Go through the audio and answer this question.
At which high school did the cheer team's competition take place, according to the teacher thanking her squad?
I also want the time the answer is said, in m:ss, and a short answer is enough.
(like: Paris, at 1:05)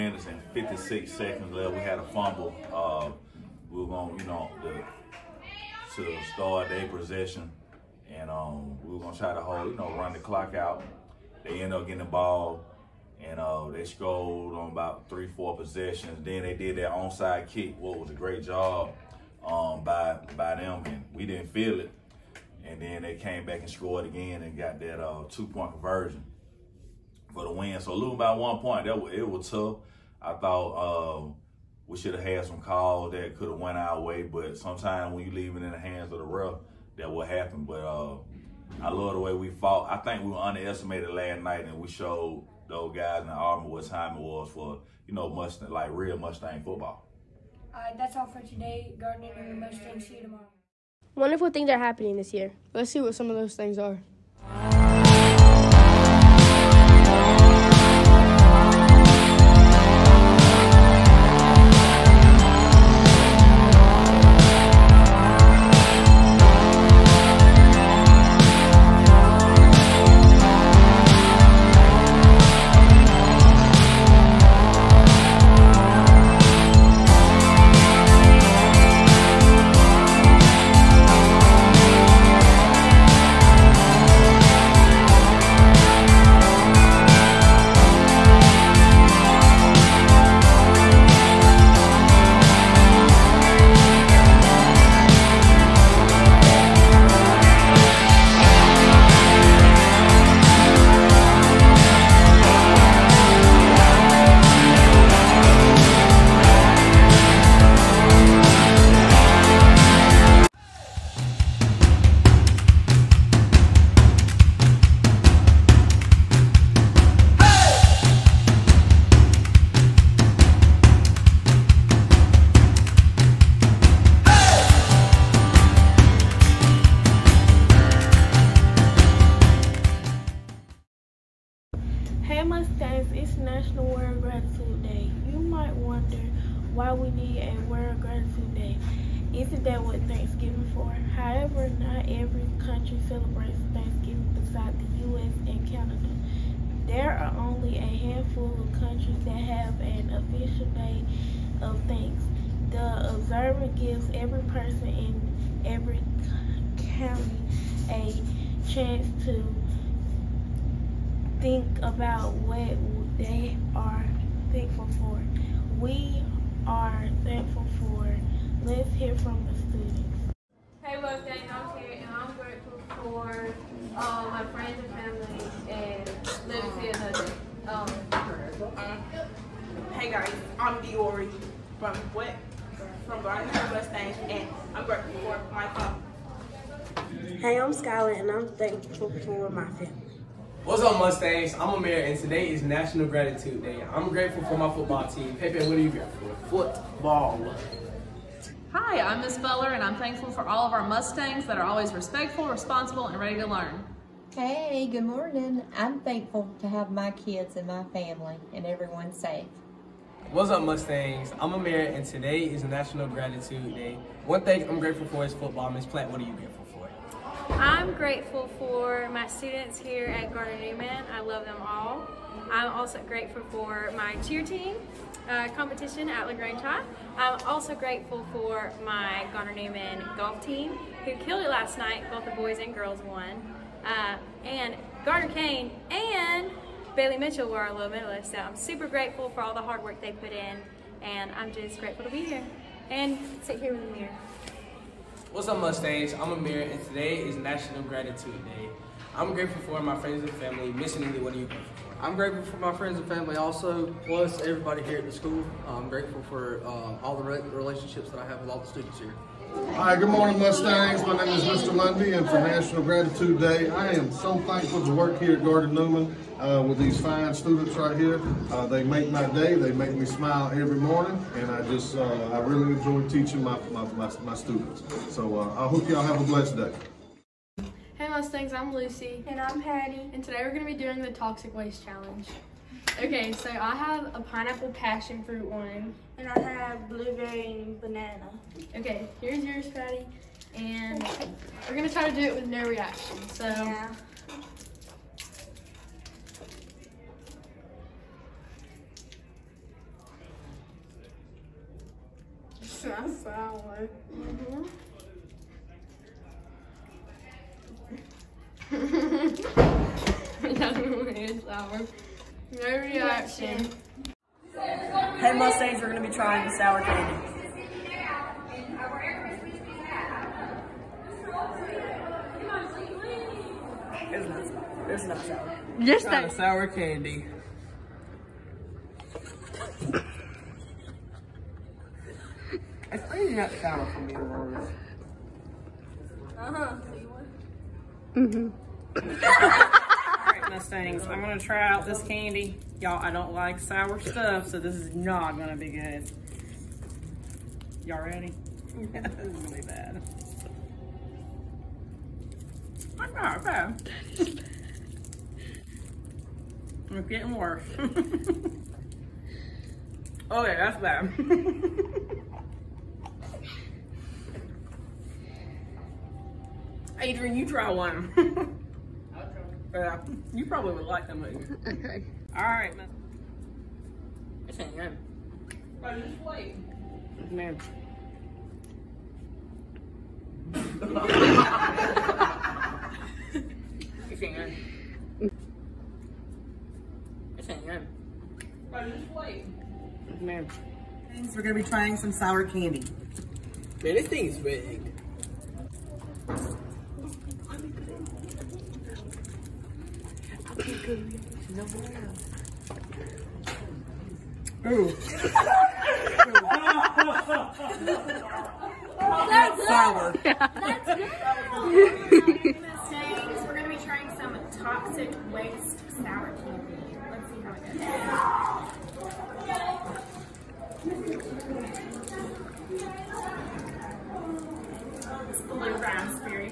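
LaGrange High, at 3:46.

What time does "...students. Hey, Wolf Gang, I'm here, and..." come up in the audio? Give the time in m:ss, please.
2:49.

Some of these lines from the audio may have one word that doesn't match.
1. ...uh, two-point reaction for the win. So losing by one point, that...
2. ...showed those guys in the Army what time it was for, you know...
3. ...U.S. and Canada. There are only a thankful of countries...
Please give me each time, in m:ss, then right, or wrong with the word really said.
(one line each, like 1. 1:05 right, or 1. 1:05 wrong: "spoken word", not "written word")
1. 0:24 wrong: "conversion", not "reaction"
2. 0:41 right
3. 2:25 wrong: "handful", not "thankful".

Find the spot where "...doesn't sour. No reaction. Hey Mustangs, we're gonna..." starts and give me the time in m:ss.
5:11.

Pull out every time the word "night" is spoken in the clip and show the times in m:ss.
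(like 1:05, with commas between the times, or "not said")
0:41, 3:51.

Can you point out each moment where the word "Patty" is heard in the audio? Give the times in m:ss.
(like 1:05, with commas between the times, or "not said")
4:39, 4:49.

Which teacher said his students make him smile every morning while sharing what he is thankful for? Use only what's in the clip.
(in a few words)
Mr. Lundy.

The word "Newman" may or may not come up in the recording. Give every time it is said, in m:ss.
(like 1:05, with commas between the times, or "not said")
3:40, 3:49, 4:25.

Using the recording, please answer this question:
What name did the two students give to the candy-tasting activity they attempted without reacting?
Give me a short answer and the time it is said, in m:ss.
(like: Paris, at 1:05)
Toxic Waste Challenge, at 4:41.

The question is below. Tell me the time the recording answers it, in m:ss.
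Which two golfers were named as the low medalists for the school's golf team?
3:55.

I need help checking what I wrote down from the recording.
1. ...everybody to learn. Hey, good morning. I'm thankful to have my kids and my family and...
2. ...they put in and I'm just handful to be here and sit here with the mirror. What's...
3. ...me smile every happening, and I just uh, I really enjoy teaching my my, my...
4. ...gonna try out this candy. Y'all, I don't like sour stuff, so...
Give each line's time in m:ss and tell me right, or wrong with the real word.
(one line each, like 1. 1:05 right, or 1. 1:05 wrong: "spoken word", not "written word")
1. 3:23 wrong: "ready", not "everybody"
2. 4:00 wrong: "grateful", not "handful"
3. 4:29 wrong: "morning", not "happening"
4. 5:41 right.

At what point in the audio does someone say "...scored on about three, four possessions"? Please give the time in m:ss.
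0:13.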